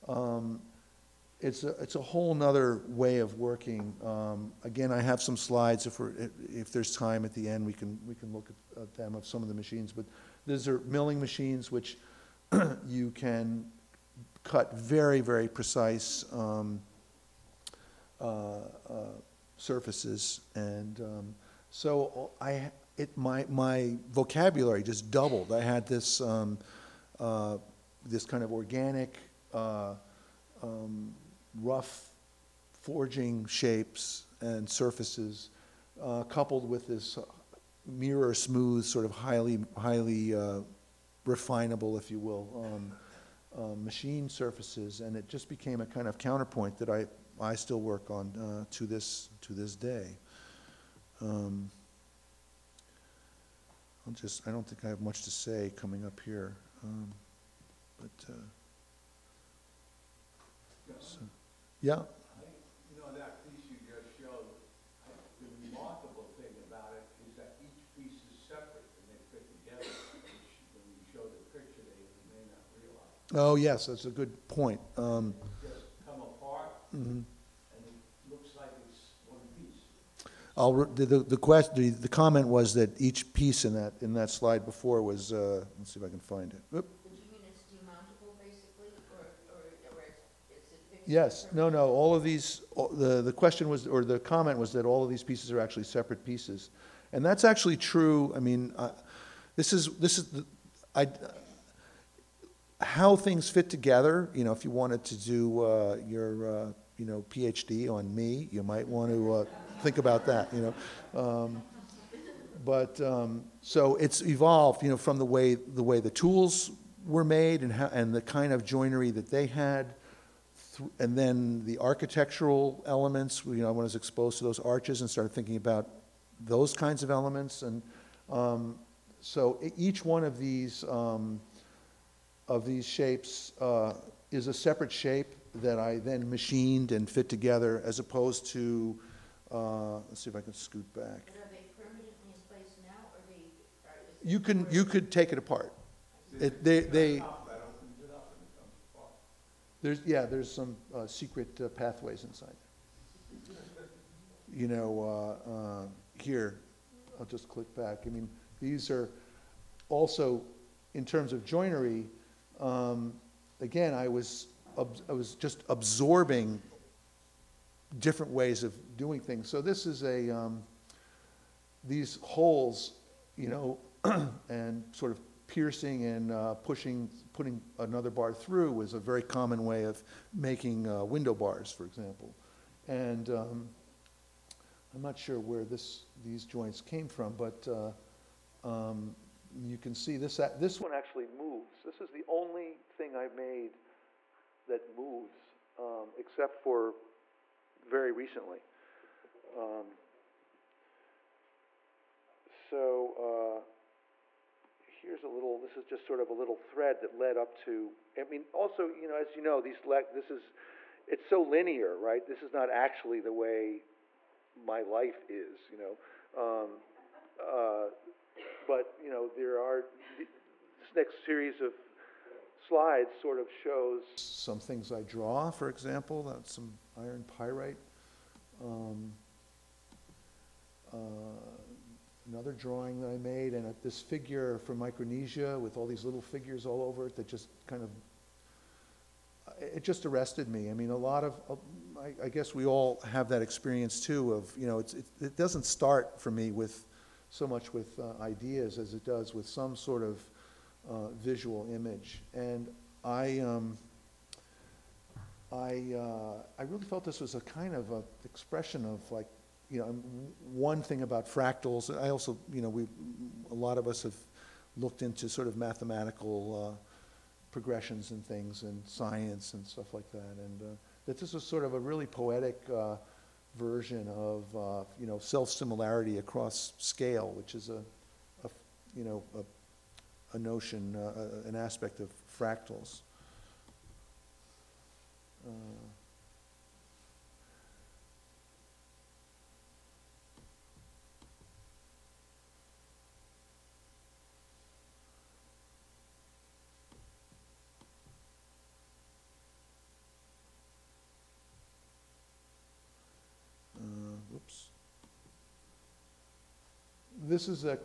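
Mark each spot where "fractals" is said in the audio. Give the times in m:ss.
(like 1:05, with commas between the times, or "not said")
4:21, 4:42.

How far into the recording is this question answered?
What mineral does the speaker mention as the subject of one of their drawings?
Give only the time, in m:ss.
3:46.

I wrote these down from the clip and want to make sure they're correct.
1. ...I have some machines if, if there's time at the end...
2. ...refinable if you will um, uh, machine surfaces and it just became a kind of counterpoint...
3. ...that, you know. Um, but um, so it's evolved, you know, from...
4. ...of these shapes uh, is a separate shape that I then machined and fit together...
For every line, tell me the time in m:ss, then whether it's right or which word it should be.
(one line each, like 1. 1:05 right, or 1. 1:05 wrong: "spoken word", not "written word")
1. 0:04 wrong: "slides", not "machines"
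2. 0:41 right
3. 1:50 right
4. 2:12 right.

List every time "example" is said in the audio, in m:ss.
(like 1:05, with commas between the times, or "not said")
3:01, 3:45.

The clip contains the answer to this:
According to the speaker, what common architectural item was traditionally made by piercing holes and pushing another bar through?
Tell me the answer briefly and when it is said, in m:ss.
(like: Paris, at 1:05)
Window bars, at 3:01.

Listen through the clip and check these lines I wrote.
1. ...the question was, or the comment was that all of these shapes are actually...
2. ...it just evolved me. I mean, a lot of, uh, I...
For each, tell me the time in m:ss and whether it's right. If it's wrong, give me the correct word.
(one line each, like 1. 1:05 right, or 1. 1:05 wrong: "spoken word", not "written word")
1. 1:33 wrong: "pieces", not "shapes"
2. 3:59 wrong: "arrested", not "evolved".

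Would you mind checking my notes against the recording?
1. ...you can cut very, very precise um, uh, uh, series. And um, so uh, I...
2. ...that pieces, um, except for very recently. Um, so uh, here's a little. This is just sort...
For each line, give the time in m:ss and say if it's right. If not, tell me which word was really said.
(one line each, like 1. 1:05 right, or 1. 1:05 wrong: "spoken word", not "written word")
1. 0:12 wrong: "surfaces", not "series"
2. 3:14 wrong: "moves", not "pieces".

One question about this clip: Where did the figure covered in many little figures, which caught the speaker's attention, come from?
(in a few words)
Micronesia.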